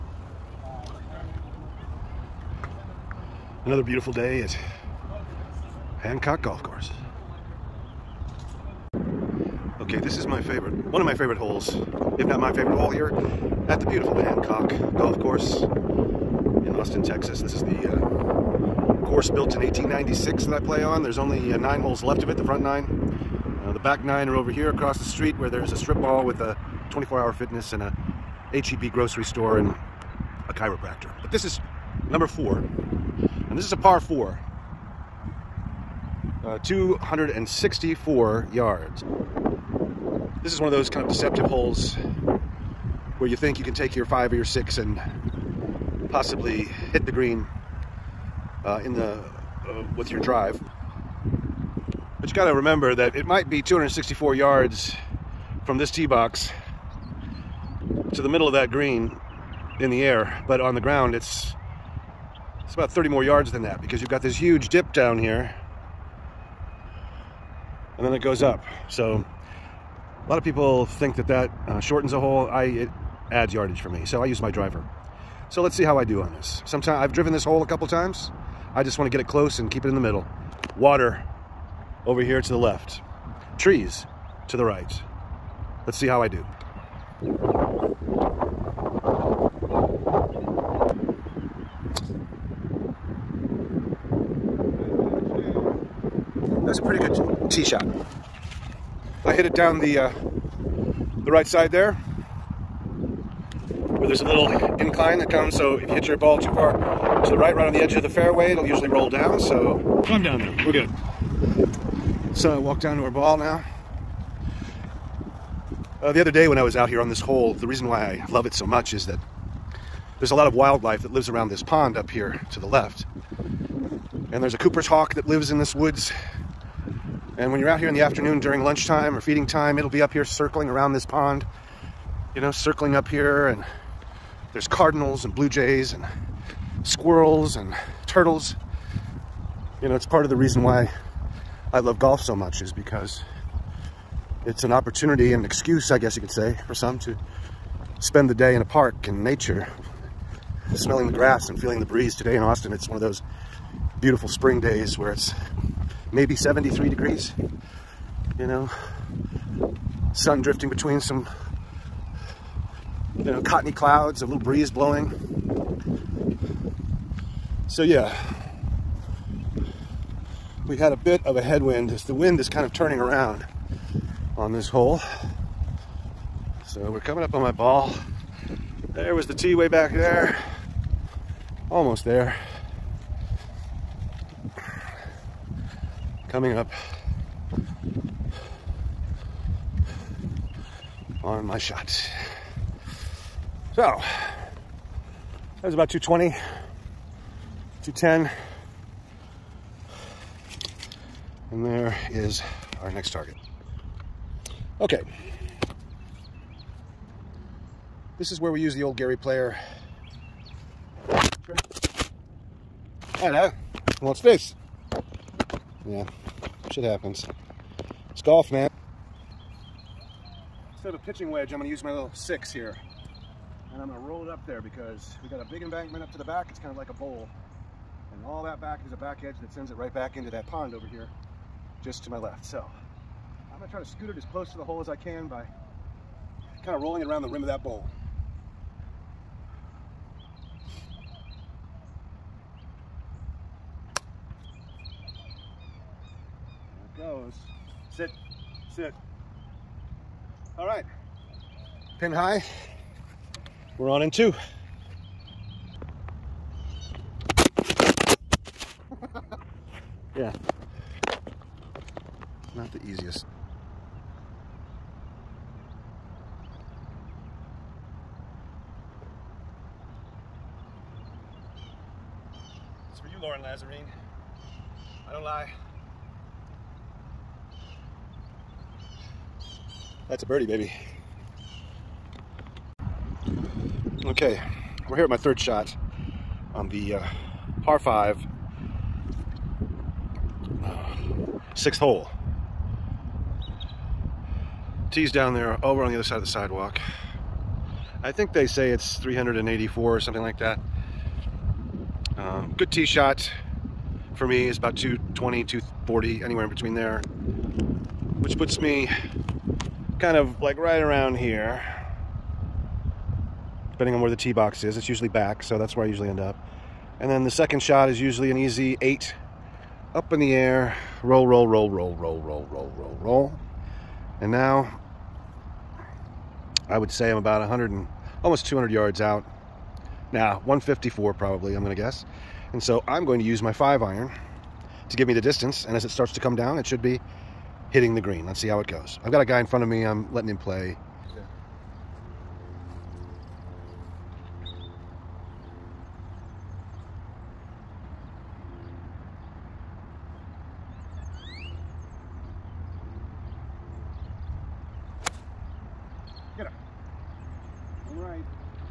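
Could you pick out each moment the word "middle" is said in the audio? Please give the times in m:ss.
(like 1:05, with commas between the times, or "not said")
0:58, 1:19.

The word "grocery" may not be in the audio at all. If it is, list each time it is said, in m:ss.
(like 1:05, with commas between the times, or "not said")
0:28.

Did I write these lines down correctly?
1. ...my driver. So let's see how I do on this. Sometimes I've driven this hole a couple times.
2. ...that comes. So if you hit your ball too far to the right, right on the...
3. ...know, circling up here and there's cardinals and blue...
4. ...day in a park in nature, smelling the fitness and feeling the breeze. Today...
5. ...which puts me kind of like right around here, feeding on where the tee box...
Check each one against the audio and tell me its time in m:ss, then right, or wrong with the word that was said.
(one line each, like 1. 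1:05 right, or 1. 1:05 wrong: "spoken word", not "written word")
1. 1:14 right
2. 1:45 right
3. 2:12 right
4. 2:28 wrong: "grass", not "fitness"
5. 5:08 wrong: "depending", not "feeding".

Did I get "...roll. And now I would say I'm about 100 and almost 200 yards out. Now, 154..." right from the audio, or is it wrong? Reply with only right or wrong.
right.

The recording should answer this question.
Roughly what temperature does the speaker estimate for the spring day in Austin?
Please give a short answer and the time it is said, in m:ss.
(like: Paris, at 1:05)
73 degrees, at 2:36.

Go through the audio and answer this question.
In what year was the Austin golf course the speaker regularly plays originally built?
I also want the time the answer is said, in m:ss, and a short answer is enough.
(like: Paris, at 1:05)
1896, at 0:19.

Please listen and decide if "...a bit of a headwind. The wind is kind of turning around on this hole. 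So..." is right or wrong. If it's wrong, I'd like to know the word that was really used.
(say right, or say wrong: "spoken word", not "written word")
right.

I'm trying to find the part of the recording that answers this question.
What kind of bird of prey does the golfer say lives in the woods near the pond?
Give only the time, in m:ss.
2:04.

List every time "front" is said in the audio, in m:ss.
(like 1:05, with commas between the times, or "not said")
0:22, 5:39.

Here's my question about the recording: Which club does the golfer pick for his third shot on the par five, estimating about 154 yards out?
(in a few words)
five iron.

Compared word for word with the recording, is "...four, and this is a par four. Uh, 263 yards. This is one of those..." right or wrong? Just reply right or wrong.
wrong.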